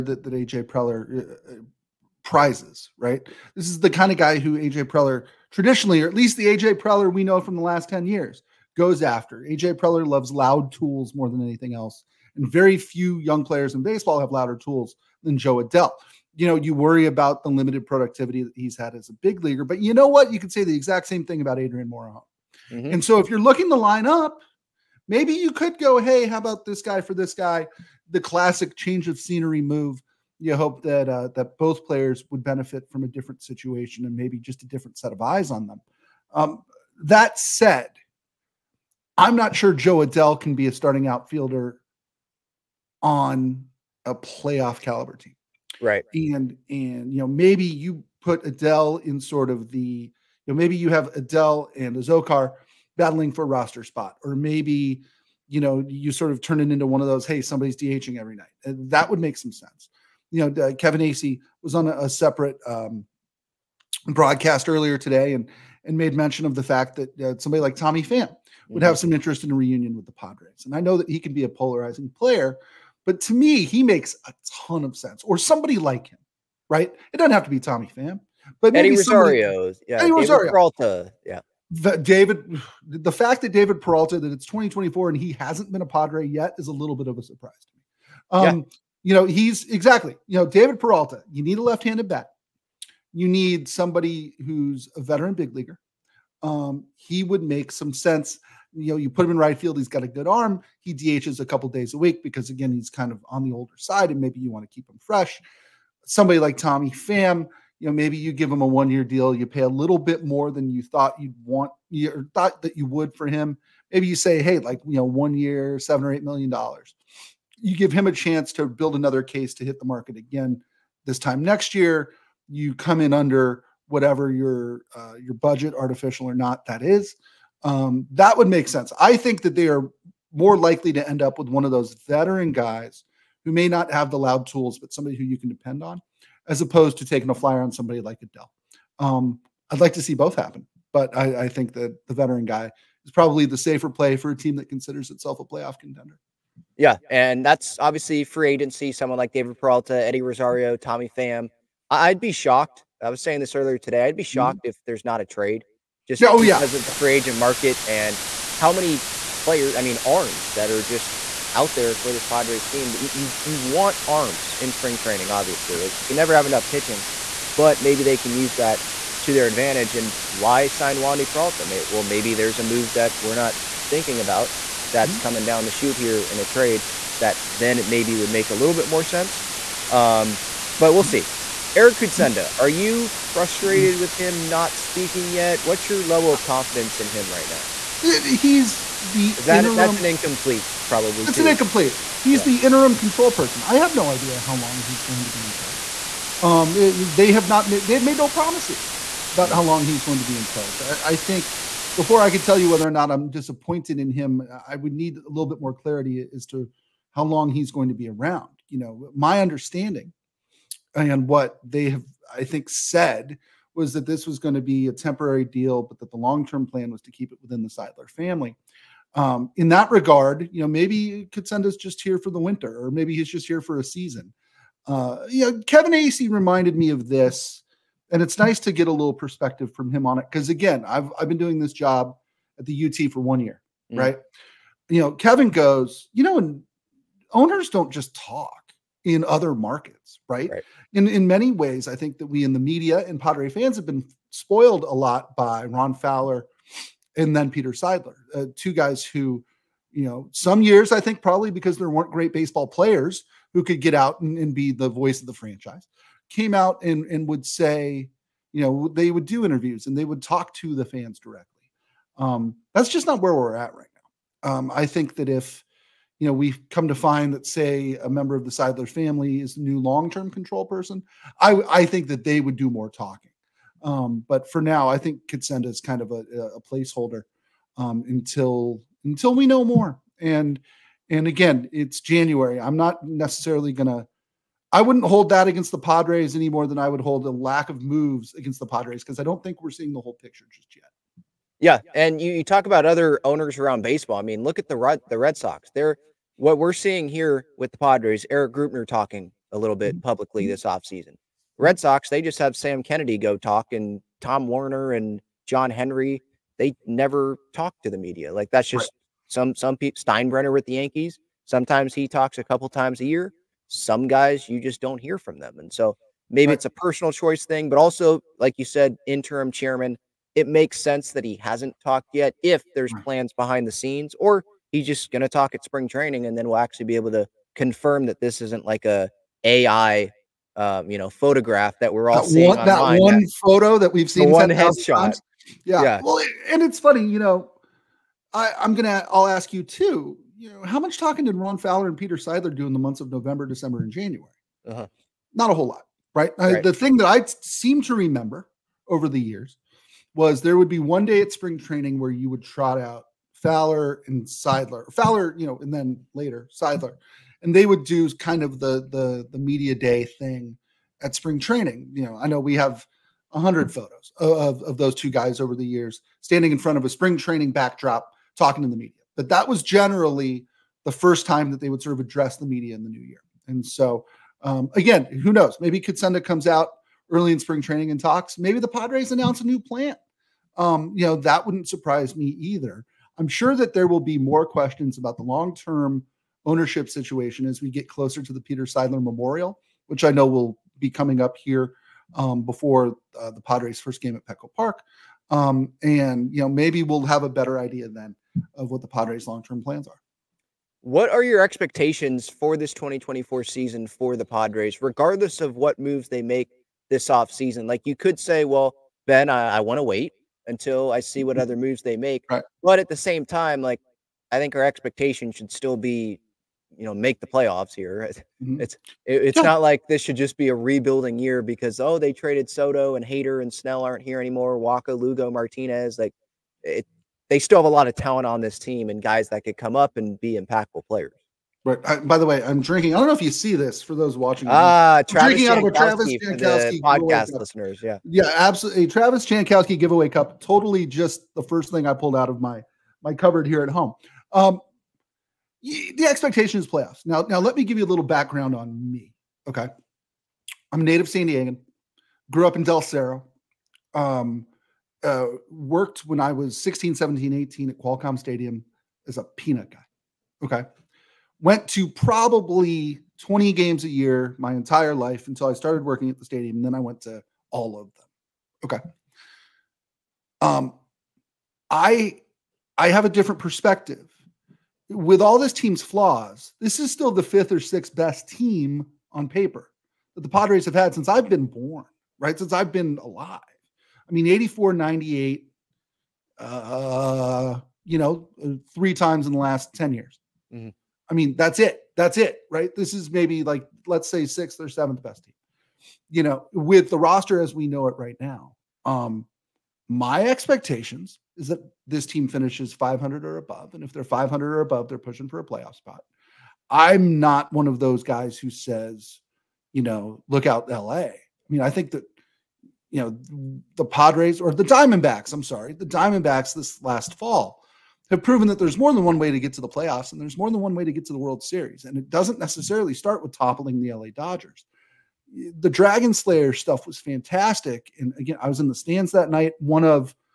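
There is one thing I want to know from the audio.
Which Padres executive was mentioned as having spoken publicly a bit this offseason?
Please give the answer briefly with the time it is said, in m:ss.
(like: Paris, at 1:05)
Erik Greupner, at 4:58.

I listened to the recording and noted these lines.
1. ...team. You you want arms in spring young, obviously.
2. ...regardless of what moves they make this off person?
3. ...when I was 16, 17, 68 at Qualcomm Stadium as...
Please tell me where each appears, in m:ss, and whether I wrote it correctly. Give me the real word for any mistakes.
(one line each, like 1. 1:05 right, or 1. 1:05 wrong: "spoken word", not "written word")
1. 2:42 wrong: "training", not "young"
2. 6:44 wrong: "season", not "person"
3. 7:36 wrong: "18", not "68".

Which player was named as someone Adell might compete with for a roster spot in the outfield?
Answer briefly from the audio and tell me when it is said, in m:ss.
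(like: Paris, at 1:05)
Azocar, at 0:51.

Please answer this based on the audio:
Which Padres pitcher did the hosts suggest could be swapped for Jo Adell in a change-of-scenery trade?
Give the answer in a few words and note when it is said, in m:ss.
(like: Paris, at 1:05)
Adrian Morejon, at 0:21.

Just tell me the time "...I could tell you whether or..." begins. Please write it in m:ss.
3:22.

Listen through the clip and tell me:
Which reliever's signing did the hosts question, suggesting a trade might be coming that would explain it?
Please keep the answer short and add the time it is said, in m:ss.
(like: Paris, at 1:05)
Wandy Peralta, at 2:50.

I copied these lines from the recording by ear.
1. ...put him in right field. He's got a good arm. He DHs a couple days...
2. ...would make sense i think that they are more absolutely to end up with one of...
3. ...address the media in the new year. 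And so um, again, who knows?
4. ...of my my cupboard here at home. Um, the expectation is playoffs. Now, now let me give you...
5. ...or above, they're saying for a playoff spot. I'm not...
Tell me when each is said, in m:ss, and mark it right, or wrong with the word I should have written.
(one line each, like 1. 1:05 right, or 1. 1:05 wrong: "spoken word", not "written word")
1. 1:39 right
2. 2:08 wrong: "likely", not "absolutely"
3. 6:12 right
4. 7:22 right
5. 8:24 wrong: "pushing", not "saying".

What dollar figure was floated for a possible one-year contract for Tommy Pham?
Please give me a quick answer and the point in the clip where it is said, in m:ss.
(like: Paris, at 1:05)
7 or 8 million dollars, at 1:55.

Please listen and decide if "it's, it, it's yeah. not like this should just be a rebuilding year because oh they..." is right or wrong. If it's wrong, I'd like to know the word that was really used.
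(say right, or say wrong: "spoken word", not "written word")
right.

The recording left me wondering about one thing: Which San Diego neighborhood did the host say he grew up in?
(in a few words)
Del Cerro.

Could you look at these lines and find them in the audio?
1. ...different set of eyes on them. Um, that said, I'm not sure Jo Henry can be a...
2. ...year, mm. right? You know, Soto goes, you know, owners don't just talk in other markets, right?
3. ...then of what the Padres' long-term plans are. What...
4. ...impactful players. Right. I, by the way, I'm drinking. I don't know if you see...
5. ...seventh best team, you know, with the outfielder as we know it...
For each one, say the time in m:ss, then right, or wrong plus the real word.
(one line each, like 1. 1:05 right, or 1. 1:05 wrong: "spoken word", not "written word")
1. 0:34 wrong: "Adell", not "Henry"
2. 3:53 wrong: "Kevin", not "Soto"
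3. 6:37 right
4. 7:10 right
5. 8:14 wrong: "roster", not "outfielder".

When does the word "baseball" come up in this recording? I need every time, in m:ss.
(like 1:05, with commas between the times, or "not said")
0:13, 4:12, 4:53.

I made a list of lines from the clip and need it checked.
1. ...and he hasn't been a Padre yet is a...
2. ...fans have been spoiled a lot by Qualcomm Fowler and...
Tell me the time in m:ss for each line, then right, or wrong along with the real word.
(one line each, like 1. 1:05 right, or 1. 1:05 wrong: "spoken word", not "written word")
1. 1:25 right
2. 4:03 wrong: "Ron", not "Qualcomm".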